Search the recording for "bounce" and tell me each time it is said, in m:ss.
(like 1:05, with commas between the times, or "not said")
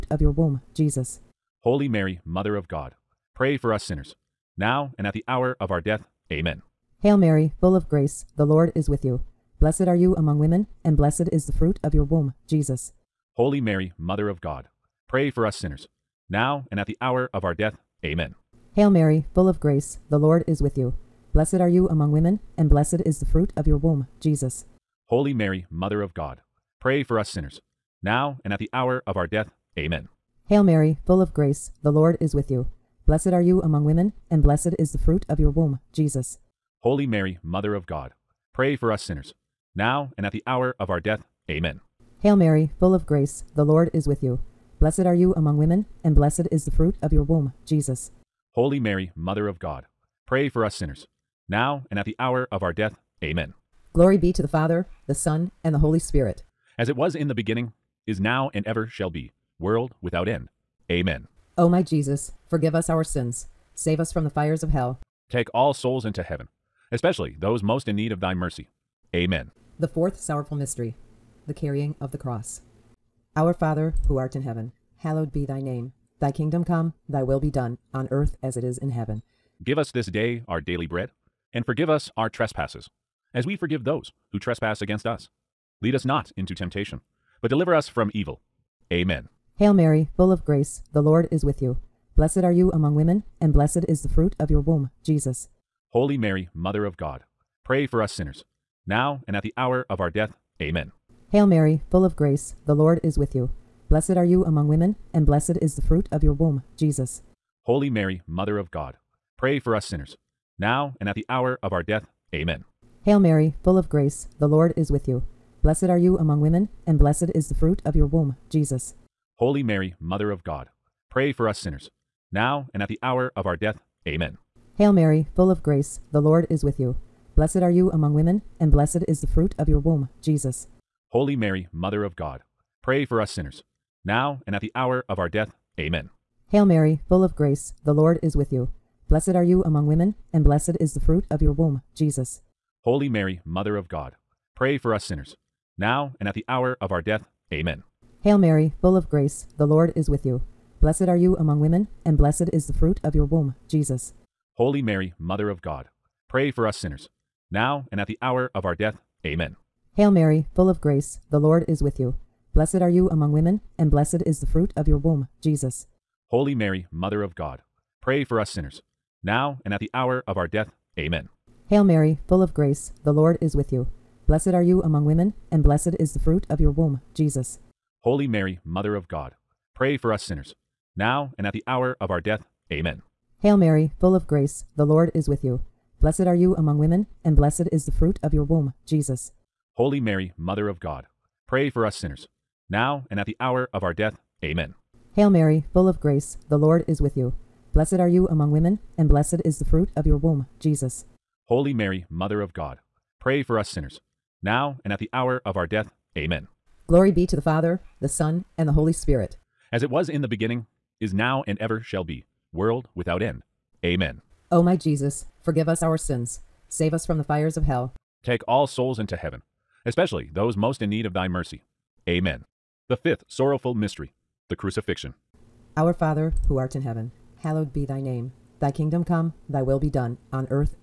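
not said.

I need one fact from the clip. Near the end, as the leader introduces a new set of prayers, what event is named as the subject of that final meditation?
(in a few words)
The crucifixion.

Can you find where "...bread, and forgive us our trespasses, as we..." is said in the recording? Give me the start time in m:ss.
1:20.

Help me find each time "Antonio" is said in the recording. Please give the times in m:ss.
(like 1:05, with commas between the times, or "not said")
not said.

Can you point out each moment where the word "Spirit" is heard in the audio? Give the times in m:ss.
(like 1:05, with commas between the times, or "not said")
0:55, 3:28.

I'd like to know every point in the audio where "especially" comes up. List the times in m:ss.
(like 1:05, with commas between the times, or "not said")
1:06, 3:39.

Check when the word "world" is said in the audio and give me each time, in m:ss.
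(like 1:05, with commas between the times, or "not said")
0:59, 3:32.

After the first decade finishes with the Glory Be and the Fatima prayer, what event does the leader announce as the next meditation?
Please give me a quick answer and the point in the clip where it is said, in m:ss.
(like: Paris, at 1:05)
The carrying of the cross, at 1:11.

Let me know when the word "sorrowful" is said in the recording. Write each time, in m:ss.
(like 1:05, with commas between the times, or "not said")
1:10, 3:43.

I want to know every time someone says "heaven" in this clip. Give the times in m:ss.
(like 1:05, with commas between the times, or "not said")
1:06, 1:14, 1:18, 3:39, 3:46.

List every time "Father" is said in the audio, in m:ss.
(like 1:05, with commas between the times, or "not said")
0:54, 1:13, 3:27, 3:45.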